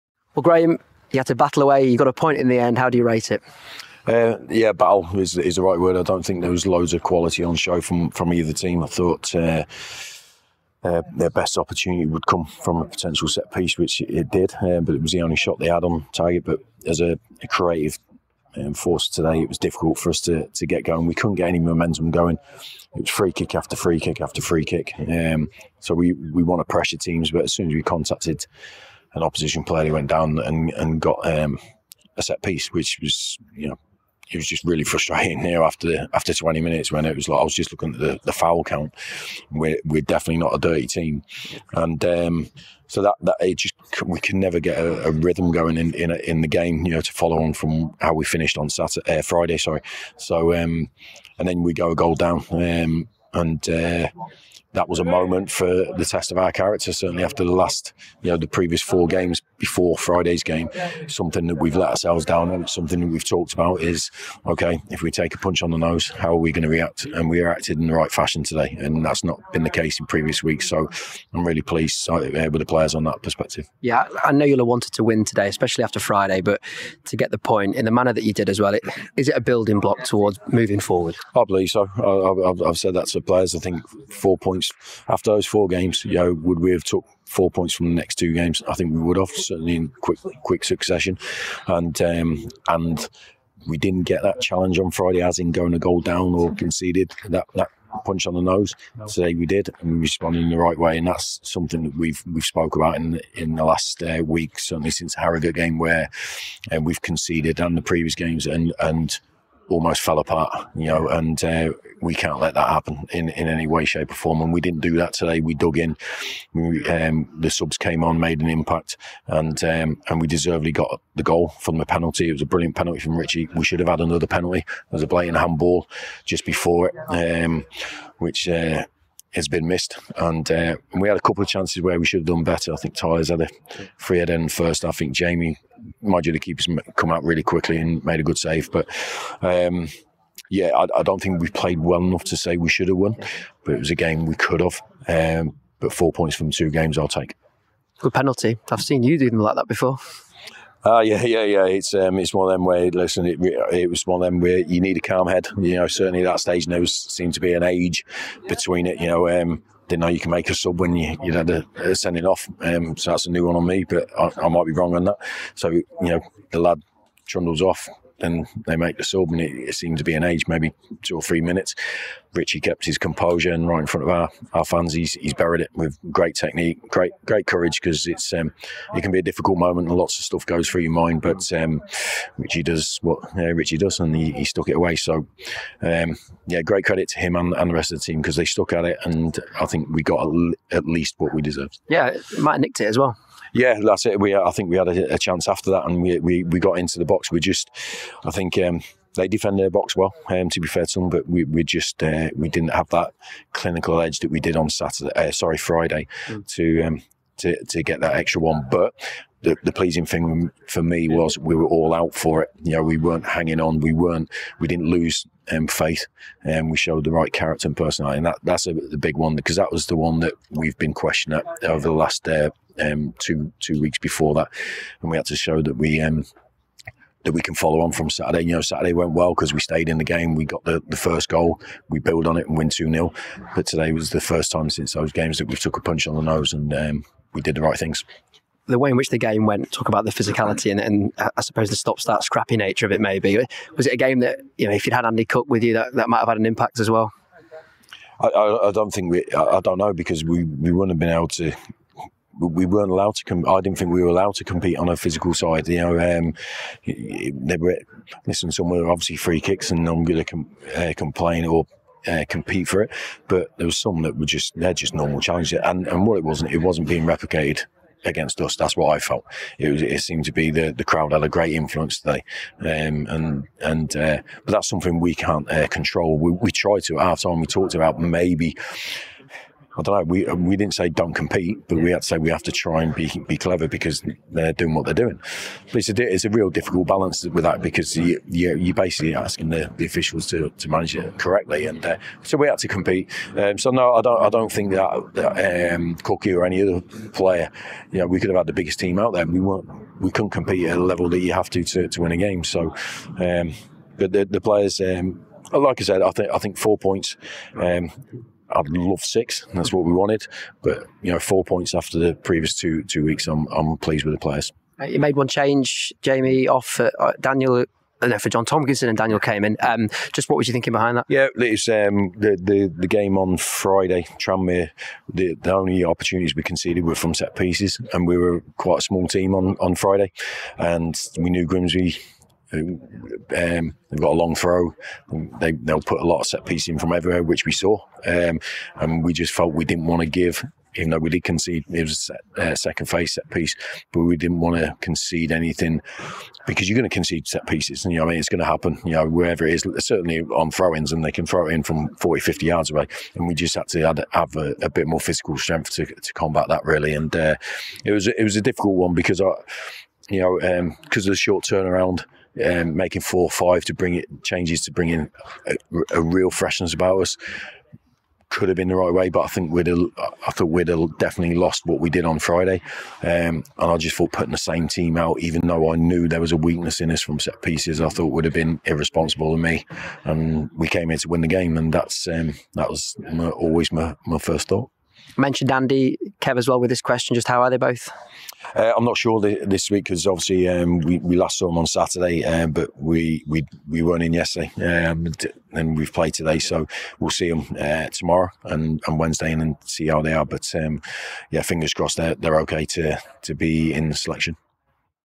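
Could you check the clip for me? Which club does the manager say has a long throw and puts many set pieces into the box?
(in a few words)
Grimsby.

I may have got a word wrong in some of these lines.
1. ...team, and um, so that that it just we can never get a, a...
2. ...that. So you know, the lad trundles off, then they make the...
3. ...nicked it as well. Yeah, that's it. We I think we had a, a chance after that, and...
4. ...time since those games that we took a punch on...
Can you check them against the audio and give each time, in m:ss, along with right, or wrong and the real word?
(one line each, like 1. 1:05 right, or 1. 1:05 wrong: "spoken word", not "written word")
1. 0:40 right
2. 2:45 right
3. 3:12 right
4. 3:54 right.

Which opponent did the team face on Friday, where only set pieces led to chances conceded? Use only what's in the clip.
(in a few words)
Tranmere.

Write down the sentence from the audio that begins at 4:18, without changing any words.
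Some were obviously free kicks, and I'm going to com- uh, complain or uh, compete for it.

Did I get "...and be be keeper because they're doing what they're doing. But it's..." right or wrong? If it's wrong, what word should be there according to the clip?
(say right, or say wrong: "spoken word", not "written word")
wrong: "clever", not "keeper".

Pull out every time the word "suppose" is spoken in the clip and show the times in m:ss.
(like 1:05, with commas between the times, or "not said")
4:01.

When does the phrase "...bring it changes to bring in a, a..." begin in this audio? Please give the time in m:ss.
6:03.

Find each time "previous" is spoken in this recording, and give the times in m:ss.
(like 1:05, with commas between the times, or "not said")
0:58, 1:10, 1:47, 5:12.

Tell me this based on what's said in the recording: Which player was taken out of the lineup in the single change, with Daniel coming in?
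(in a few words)
John Tomkinson.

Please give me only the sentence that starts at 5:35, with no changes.
They, they'll put a lot of set pieces in from everywhere, which we saw.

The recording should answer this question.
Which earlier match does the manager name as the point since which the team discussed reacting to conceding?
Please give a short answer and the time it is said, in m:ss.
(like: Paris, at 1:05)
Harrogate, at 1:45.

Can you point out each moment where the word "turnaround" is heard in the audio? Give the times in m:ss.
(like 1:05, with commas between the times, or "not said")
6:01.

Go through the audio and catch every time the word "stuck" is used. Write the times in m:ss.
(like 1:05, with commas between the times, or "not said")
3:04, 3:08.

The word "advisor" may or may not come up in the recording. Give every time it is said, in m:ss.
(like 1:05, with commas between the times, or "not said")
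not said.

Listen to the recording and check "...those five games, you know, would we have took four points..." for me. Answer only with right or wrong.
wrong.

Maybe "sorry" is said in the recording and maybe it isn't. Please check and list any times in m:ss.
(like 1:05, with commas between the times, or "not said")
0:49, 3:25.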